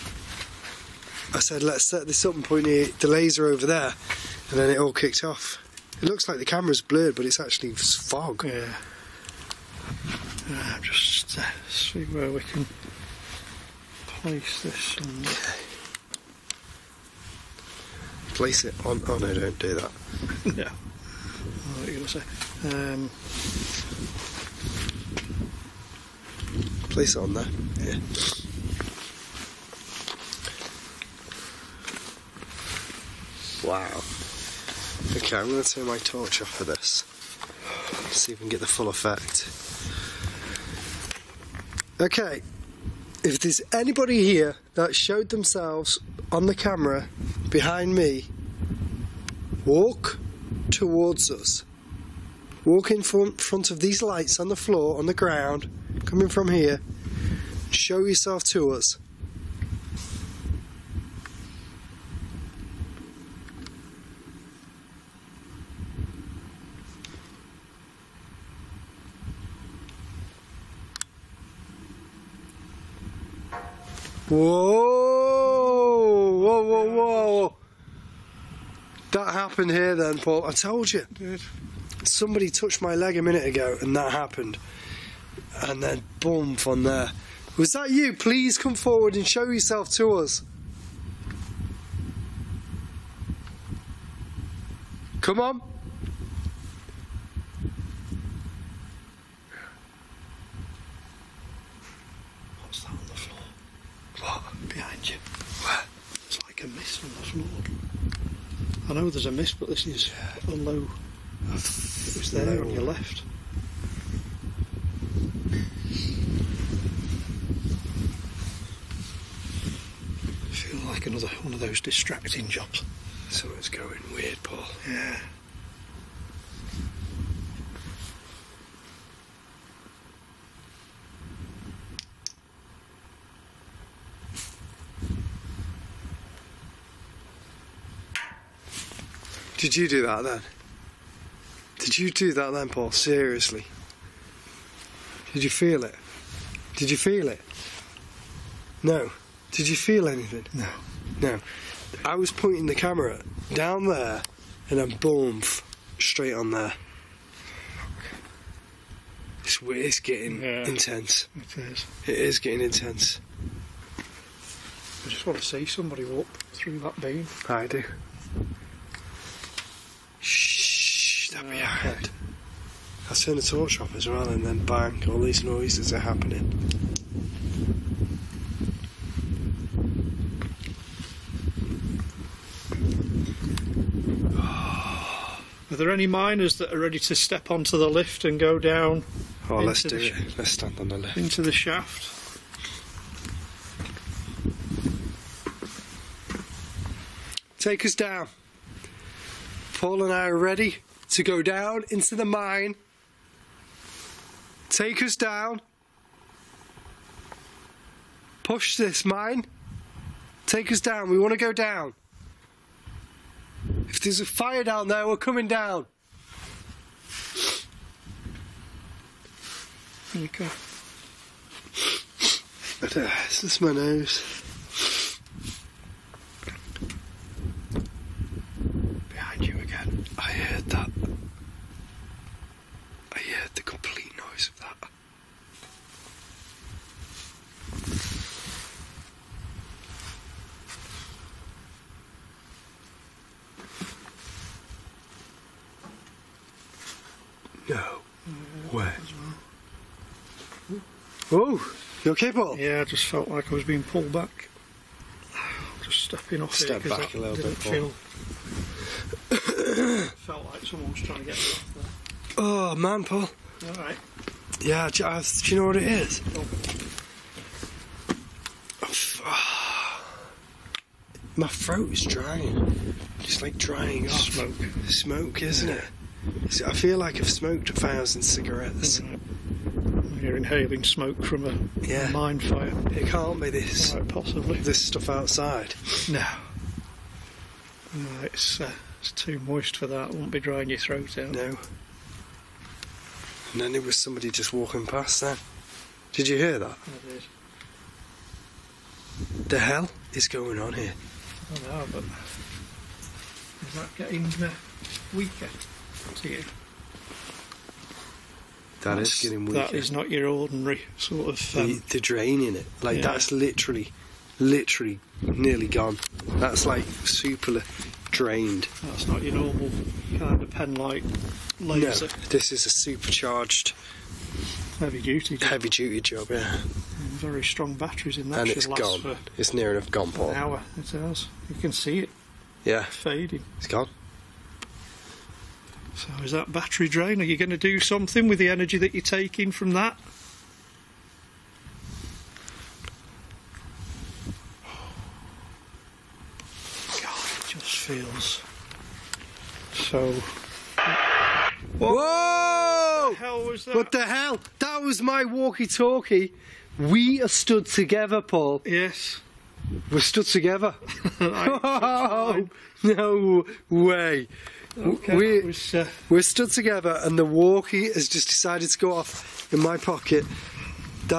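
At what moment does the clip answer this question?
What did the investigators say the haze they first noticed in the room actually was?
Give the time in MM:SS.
00:07.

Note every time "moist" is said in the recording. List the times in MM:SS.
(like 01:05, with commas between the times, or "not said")
04:49.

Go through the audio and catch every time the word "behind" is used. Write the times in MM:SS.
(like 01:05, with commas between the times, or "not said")
00:47, 02:51.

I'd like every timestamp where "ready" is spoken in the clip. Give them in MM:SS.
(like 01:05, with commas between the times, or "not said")
03:06, 03:20.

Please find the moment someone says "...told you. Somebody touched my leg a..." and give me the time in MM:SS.
01:20.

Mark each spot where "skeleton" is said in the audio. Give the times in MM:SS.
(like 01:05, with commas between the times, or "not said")
not said.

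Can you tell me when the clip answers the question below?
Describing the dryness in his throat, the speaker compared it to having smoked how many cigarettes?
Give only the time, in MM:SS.
04:37.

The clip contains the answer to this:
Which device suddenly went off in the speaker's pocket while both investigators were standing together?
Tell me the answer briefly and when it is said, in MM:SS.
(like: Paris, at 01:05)
walkie-talkie, at 05:55.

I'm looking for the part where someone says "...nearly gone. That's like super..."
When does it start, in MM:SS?
05:15.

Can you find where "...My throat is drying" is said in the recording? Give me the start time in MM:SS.
04:31.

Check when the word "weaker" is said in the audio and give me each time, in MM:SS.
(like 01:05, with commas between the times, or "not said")
05:05, 05:09.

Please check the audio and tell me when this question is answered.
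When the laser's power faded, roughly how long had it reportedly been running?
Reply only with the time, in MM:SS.
05:30.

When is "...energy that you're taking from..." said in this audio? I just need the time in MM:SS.
05:38.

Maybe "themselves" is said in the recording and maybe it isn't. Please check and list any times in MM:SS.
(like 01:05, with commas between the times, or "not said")
00:45.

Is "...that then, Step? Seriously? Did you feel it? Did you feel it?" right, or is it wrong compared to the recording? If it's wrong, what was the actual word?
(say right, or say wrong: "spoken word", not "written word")
wrong: "Paul", not "Step".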